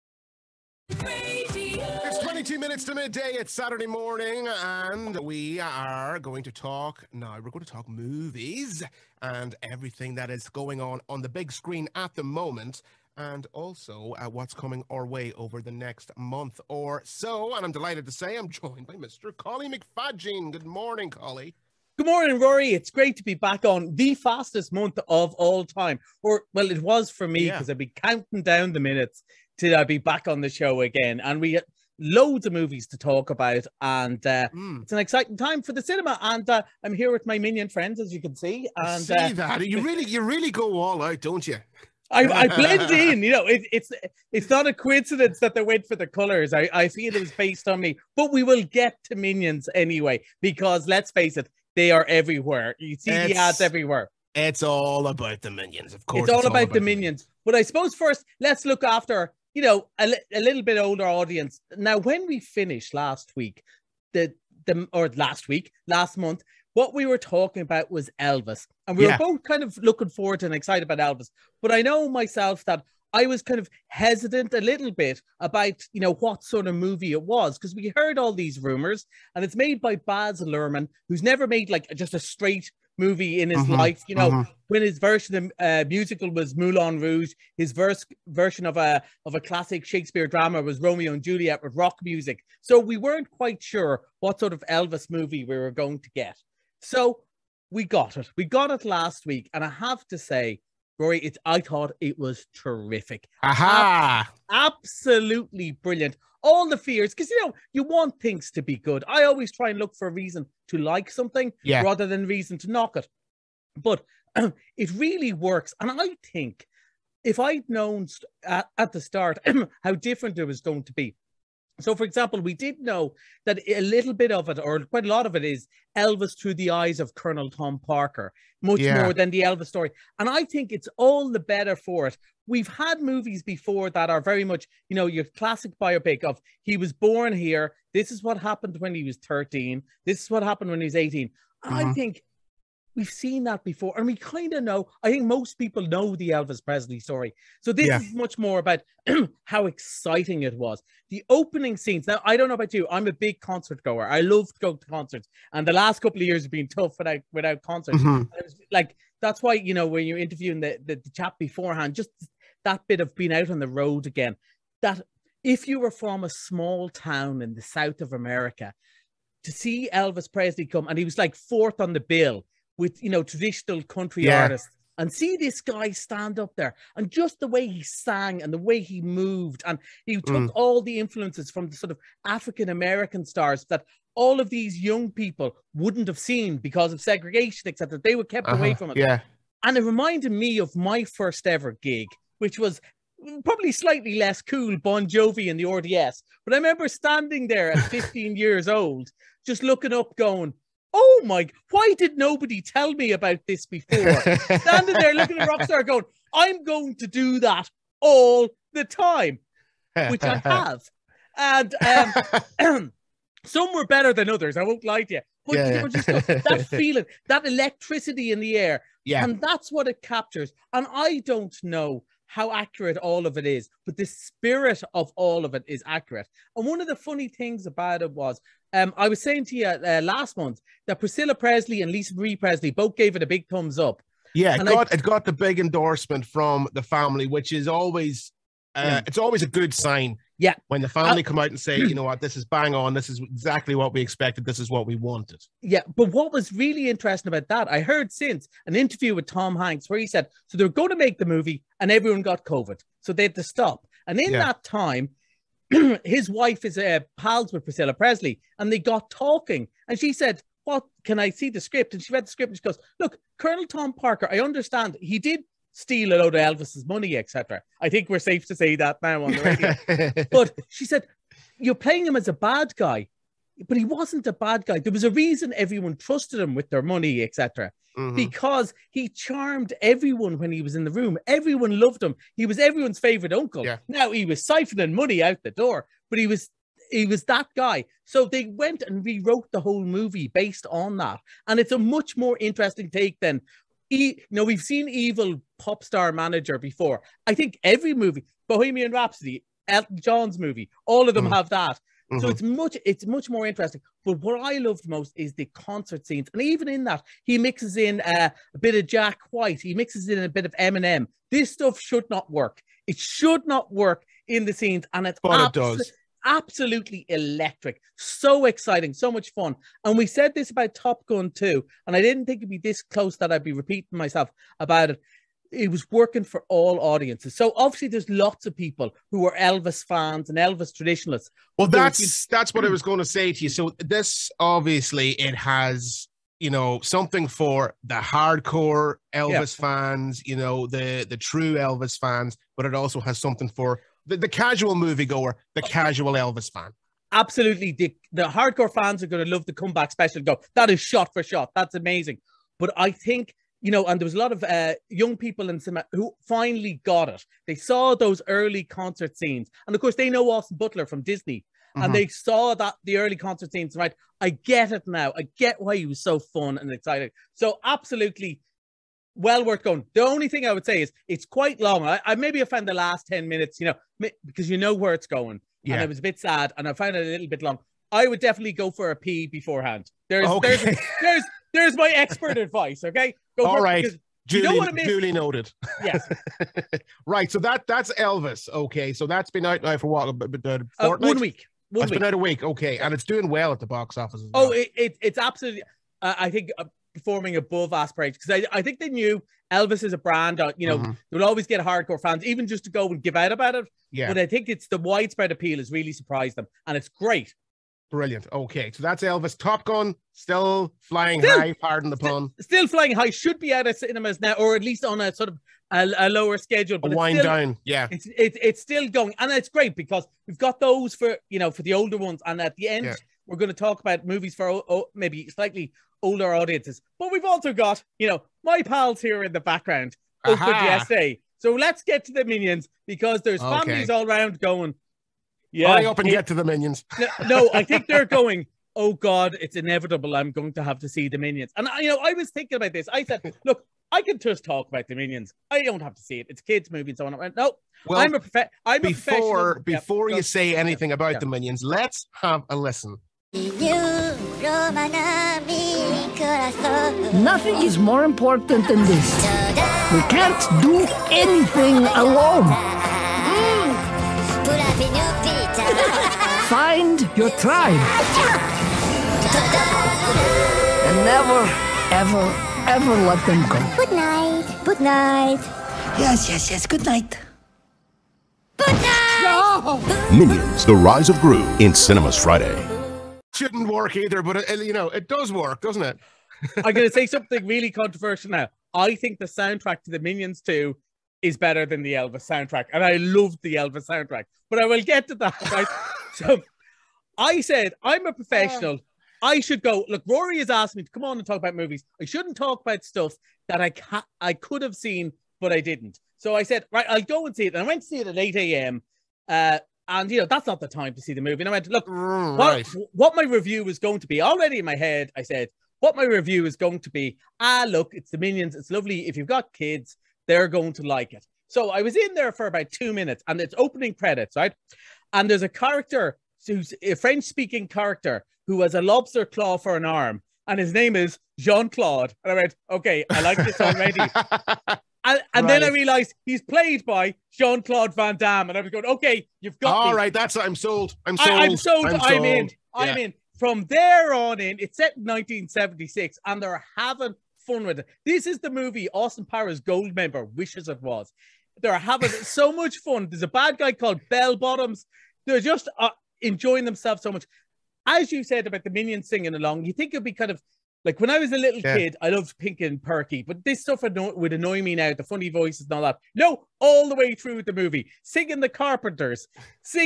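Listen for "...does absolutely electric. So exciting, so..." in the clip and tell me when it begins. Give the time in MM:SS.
05:15.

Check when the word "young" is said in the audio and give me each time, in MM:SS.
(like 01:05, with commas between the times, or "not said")
03:04, 05:54.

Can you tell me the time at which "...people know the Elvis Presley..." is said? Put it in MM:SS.
02:25.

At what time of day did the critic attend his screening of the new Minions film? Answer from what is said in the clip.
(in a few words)
8 a.m.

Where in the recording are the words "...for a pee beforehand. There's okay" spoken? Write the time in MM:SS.
06:18.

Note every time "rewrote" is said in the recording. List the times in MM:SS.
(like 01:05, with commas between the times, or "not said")
04:49.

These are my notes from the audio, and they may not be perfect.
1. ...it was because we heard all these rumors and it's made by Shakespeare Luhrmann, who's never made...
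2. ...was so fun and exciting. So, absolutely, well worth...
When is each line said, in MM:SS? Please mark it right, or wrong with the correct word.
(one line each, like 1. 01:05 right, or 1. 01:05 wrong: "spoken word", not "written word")
1. 01:17 wrong: "Baz", not "Shakespeare"
2. 06:05 right.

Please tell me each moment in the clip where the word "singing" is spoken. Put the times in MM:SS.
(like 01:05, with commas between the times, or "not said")
09:19, 09:28.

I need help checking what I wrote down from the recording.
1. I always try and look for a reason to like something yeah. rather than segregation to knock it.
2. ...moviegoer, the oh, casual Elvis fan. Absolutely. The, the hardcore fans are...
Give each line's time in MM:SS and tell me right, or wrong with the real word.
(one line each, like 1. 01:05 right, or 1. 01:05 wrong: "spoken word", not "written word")
1. 01:49 wrong: "reason", not "segregation"
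2. 05:44 right.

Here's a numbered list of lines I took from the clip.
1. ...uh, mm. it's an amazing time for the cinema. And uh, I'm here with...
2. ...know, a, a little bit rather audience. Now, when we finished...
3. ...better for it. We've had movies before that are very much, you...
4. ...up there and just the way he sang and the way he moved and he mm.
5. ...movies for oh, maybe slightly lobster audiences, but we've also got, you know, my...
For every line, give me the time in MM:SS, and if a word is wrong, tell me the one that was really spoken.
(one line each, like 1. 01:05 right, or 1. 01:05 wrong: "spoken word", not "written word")
1. 00:34 wrong: "exciting", not "amazing"
2. 00:59 wrong: "older", not "rather"
3. 02:11 right
4. 02:56 right
5. 07:04 wrong: "older", not "lobster".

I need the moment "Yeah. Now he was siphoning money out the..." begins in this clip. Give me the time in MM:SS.
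04:43.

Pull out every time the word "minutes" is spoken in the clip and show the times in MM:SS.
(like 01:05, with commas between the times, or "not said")
00:02, 00:28, 06:13, 08:42.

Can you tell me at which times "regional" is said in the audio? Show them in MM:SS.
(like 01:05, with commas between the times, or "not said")
not said.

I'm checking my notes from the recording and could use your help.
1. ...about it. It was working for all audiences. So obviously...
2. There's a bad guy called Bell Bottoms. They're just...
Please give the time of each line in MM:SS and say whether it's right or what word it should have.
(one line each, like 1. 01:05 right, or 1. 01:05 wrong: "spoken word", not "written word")
1. 05:24 right
2. 09:13 right.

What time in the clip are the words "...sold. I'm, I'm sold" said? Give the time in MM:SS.
09:01.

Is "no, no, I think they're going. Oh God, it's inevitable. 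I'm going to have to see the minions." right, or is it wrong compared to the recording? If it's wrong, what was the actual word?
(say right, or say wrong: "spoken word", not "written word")
right.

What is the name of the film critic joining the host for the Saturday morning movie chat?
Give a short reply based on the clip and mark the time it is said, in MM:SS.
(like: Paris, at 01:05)
Collie McFadgen, at 00:19.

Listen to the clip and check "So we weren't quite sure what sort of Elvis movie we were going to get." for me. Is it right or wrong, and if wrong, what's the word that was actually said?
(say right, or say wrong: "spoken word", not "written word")
right.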